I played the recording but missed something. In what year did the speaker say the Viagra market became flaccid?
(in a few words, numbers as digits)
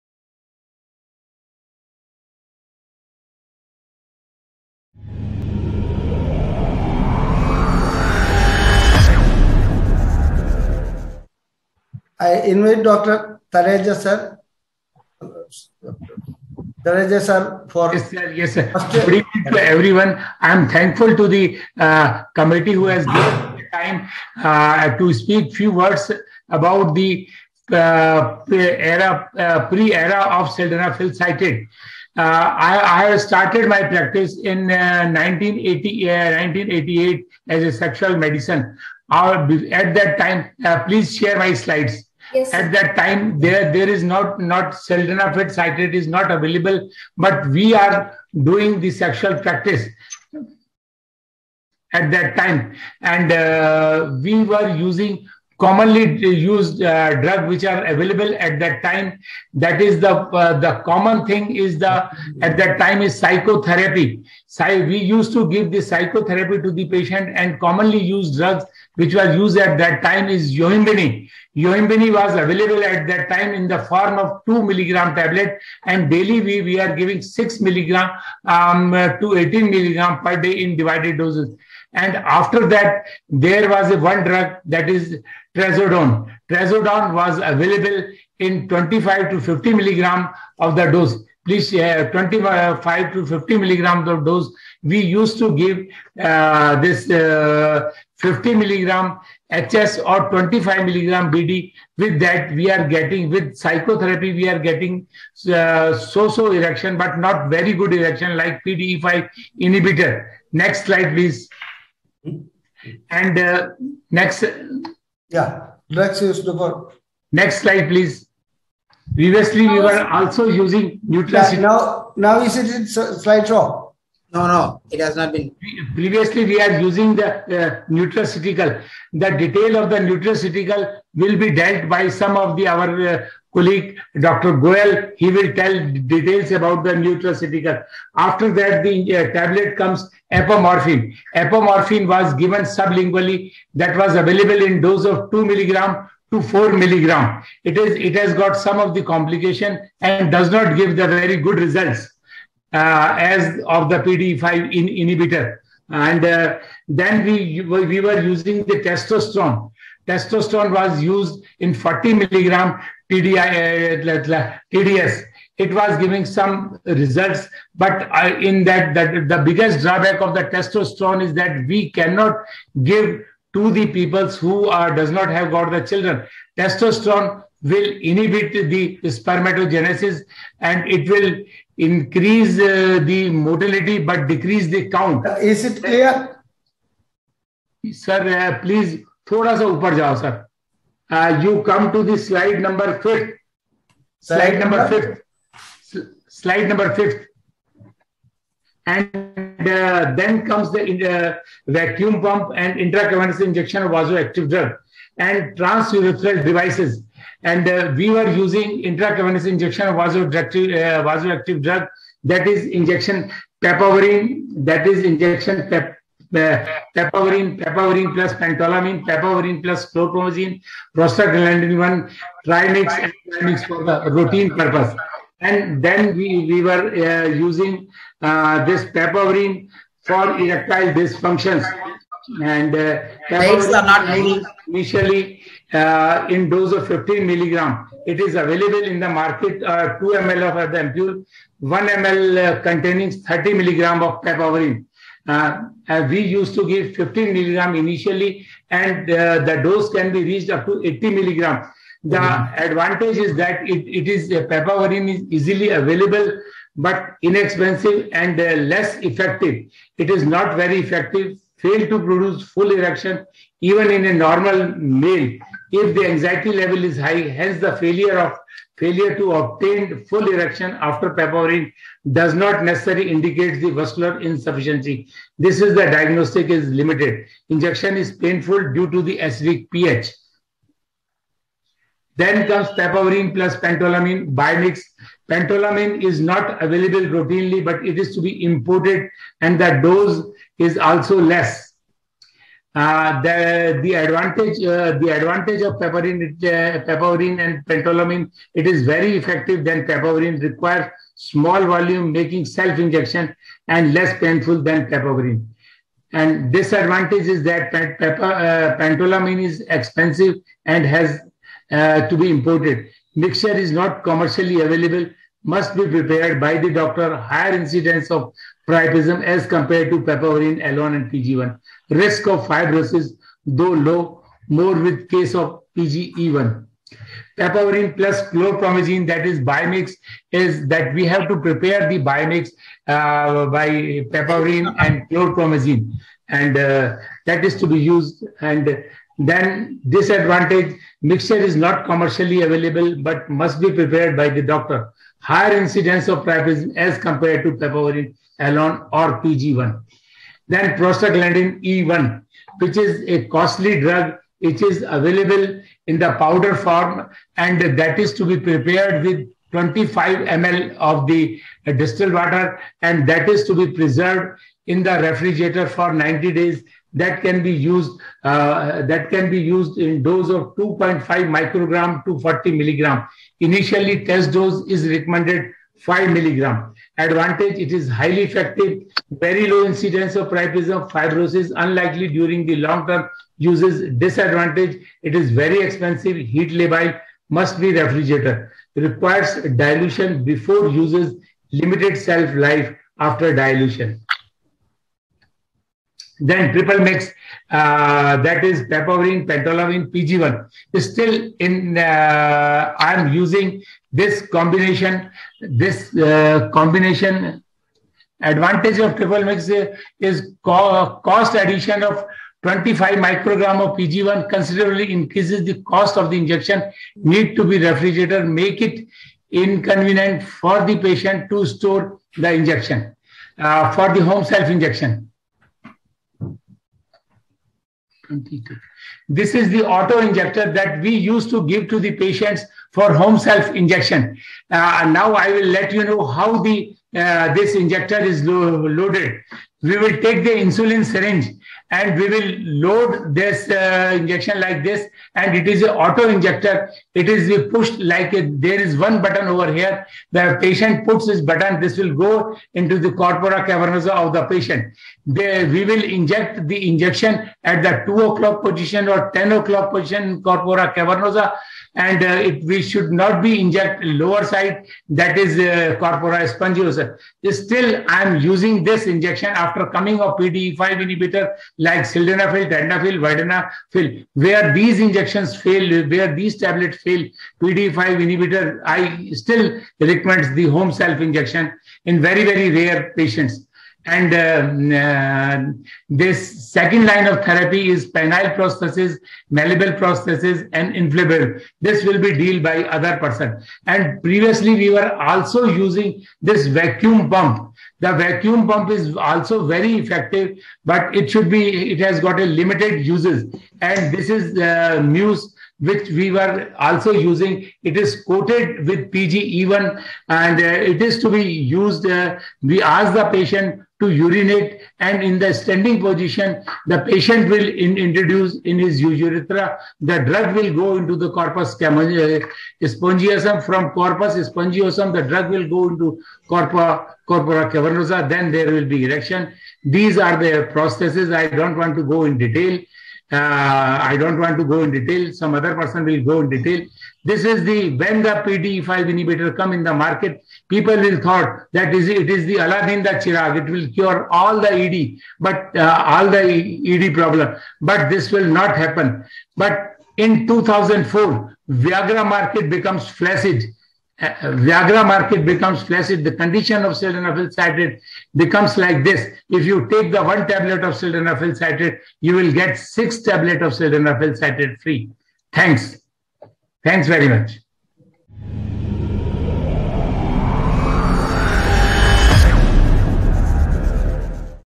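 2004.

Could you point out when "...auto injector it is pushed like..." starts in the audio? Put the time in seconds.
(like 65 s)
445 s.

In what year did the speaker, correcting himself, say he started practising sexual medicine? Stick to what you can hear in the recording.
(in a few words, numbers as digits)
1988.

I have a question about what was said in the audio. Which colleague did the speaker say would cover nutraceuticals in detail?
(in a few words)
Dr. Goel.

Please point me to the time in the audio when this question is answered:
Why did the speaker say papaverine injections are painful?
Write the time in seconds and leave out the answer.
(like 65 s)
279 s.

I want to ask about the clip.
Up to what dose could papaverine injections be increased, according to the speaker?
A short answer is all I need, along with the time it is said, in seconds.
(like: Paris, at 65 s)
80 milligram, at 250 s.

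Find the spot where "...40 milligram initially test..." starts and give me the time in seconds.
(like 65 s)
372 s.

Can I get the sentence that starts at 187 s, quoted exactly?
Sir, uh, please, thoda sa upar jao, sir.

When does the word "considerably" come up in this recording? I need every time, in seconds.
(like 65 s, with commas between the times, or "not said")
414 s.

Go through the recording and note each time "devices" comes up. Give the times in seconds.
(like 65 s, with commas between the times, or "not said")
206 s.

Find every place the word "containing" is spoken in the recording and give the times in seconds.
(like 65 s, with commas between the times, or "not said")
242 s.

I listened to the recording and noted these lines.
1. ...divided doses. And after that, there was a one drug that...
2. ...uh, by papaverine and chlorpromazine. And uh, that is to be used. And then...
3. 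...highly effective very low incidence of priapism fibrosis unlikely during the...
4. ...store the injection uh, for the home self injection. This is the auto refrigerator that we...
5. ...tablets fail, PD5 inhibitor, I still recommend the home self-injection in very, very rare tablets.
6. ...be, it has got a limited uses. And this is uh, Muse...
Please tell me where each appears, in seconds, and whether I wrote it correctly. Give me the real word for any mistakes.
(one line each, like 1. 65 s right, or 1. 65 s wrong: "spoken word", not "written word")
1. 80 s right
2. 332 s right
3. 377 s right
4. 421 s wrong: "injector", not "refrigerator"
5. 476 s wrong: "patients", not "tablets"
6. 501 s right.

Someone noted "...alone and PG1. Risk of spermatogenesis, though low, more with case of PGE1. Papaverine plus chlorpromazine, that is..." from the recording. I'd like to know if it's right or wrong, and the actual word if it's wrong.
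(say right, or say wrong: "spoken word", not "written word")
wrong: "fibrosis", not "spermatogenesis".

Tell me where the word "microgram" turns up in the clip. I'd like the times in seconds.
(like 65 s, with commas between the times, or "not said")
371 s, 412 s.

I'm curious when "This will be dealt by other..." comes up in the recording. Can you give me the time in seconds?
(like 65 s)
491 s.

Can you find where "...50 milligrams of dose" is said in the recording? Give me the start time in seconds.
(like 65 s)
93 s.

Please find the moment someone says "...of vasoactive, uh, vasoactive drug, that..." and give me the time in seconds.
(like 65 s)
209 s.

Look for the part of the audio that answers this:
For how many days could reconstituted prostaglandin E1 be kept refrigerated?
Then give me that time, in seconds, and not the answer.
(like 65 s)
365 s.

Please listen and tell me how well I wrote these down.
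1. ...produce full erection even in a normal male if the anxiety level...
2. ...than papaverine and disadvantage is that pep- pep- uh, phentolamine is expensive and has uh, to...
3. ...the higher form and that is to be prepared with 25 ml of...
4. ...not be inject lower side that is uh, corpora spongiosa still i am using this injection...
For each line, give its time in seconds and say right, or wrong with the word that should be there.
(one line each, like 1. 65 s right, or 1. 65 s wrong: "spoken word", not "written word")
1. 262 s right
2. 304 s right
3. 355 s wrong: "powder", not "higher"
4. 462 s right.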